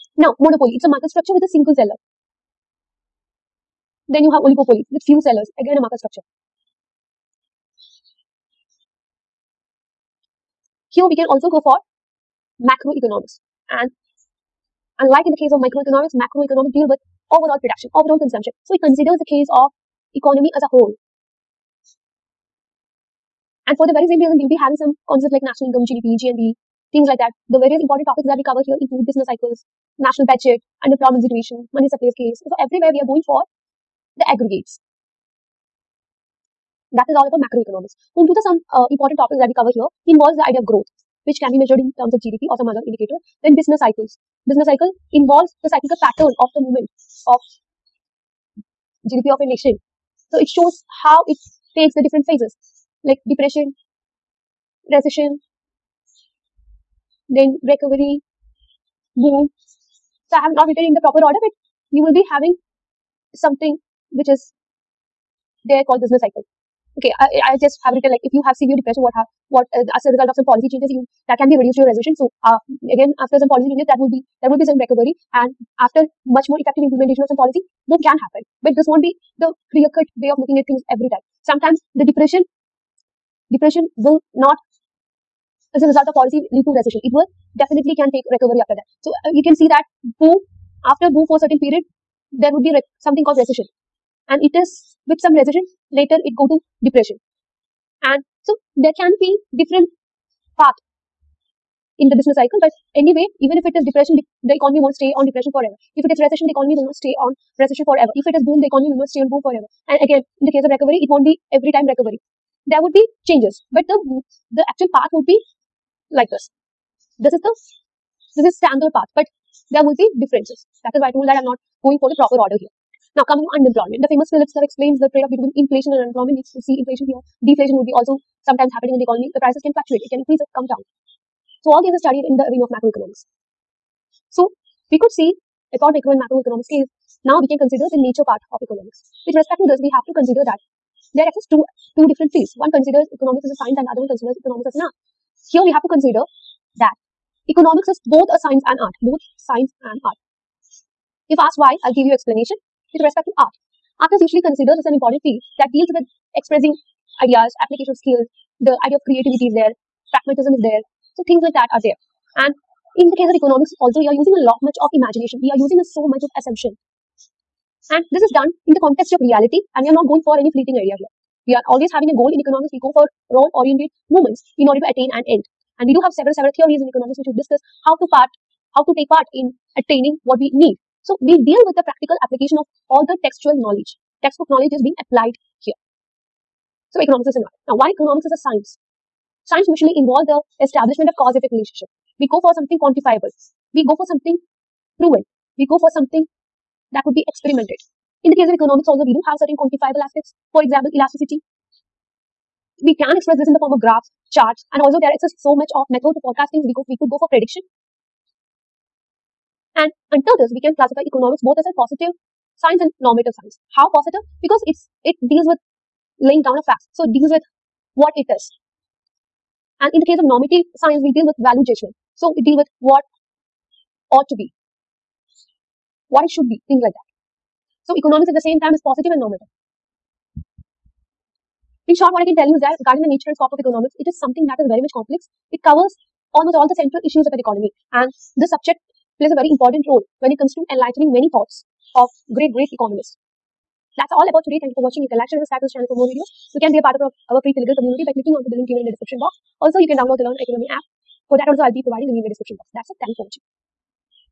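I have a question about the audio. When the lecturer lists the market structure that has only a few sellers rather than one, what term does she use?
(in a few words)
Oligopolies.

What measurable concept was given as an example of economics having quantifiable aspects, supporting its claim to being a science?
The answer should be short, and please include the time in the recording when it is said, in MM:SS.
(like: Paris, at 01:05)
Elasticity, at 03:20.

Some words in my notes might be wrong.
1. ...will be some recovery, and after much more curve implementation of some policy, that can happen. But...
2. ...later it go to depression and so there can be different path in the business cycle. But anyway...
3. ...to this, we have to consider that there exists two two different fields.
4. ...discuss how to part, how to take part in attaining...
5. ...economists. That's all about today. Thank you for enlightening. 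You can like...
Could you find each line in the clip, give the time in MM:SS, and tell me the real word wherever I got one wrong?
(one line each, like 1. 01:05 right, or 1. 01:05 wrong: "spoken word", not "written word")
1. 01:14 wrong: "effective", not "curve"
2. 01:35 right
3. 02:19 right
4. 02:57 right
5. 04:02 wrong: "watching", not "enlightening".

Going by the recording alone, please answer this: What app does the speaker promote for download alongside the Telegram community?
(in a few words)
Learn Oikonomia.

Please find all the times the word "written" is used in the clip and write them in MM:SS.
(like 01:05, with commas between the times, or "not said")
01:00, 01:07.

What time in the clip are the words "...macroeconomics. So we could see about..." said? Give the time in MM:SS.
02:12.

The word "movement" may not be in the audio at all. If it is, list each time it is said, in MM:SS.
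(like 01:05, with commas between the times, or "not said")
00:46, 02:54.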